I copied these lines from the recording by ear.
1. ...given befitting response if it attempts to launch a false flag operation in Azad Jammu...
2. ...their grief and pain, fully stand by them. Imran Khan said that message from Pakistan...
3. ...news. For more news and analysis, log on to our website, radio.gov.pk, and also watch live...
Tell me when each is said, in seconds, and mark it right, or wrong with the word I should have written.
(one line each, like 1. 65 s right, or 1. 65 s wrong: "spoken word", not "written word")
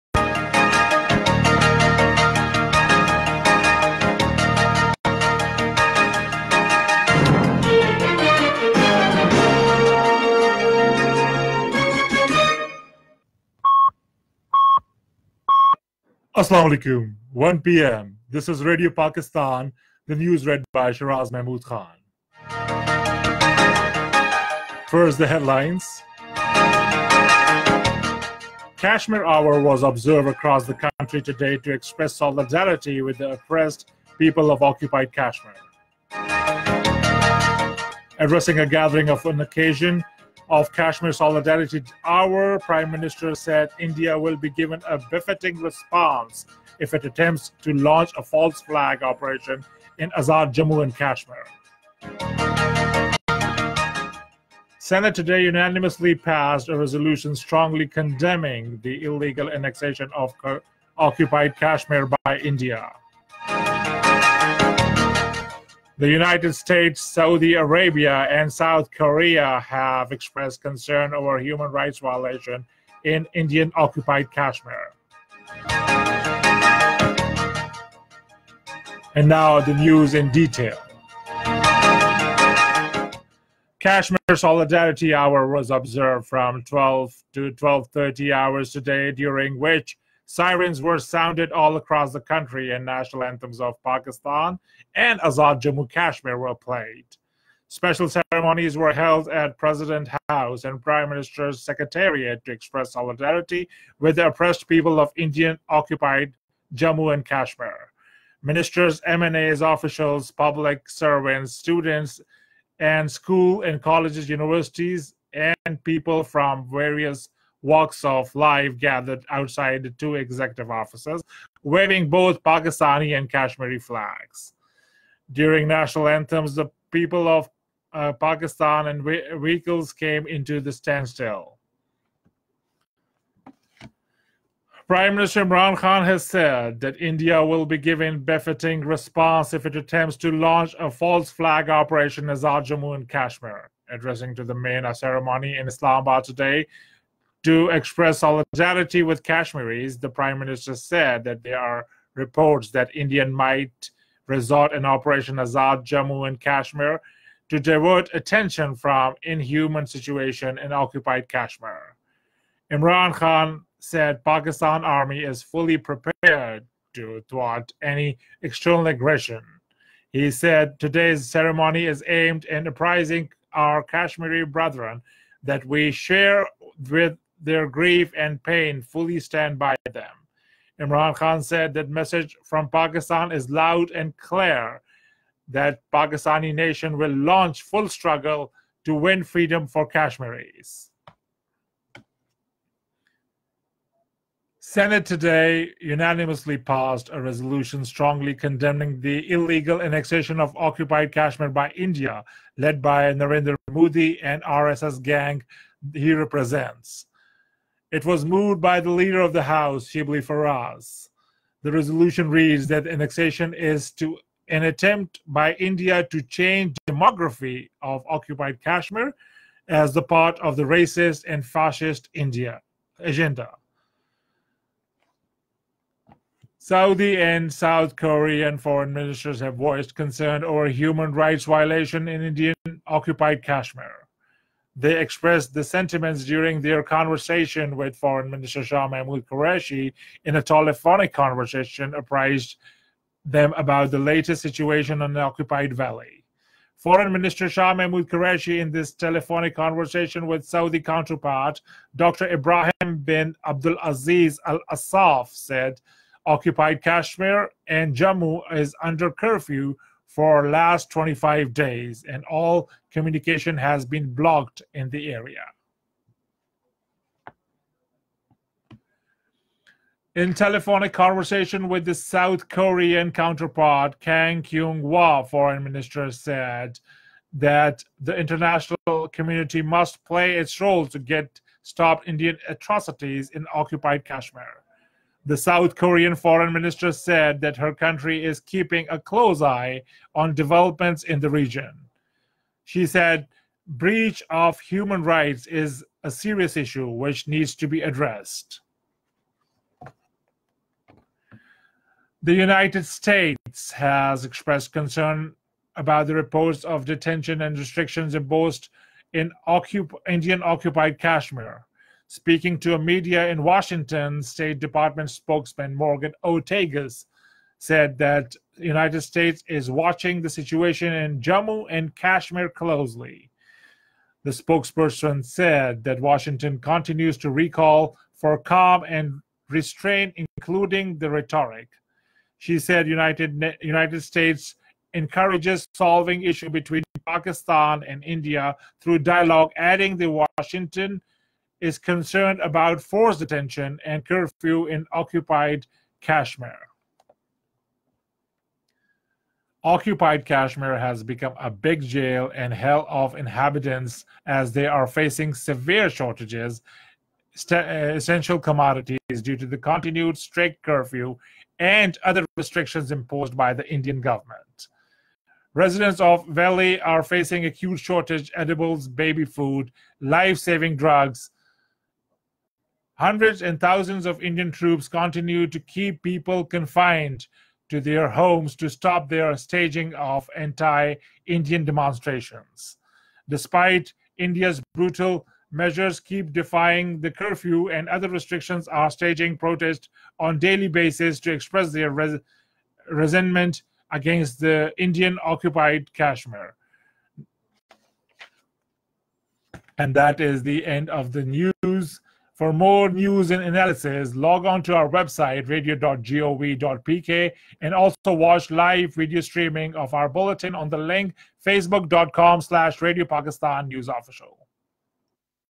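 1. 137 s right
2. 177 s right
3. 401 s right.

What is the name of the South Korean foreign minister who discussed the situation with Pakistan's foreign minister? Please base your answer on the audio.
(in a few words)
Kang Kyung-hwa.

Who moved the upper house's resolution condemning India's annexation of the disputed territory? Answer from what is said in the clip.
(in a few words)
Shibli Faraz.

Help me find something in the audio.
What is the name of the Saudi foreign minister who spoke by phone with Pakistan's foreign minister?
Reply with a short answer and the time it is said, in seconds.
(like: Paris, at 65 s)
Dr. Ibrahim bin Abdul Aziz Al Asaf, at 251 s.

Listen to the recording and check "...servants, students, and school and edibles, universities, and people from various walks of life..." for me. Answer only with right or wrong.
wrong.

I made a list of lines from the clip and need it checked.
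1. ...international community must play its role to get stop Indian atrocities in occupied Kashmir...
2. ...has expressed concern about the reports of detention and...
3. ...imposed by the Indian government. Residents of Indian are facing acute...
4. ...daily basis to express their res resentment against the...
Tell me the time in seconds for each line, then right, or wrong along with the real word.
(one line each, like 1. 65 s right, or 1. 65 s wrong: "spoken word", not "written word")
1. 278 s right
2. 303 s right
3. 362 s wrong: "Valley", not "Indian"
4. 390 s right.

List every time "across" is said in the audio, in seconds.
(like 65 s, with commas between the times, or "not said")
30 s, 91 s.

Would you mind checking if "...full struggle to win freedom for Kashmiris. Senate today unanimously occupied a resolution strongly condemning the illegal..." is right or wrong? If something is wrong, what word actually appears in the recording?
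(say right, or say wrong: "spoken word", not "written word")
wrong: "passed", not "occupied".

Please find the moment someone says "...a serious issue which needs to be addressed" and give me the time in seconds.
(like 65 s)
296 s.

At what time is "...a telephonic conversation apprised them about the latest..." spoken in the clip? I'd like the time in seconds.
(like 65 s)
240 s.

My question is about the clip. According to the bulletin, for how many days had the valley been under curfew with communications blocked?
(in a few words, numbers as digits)
25 days.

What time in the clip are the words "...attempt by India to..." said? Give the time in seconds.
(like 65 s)
214 s.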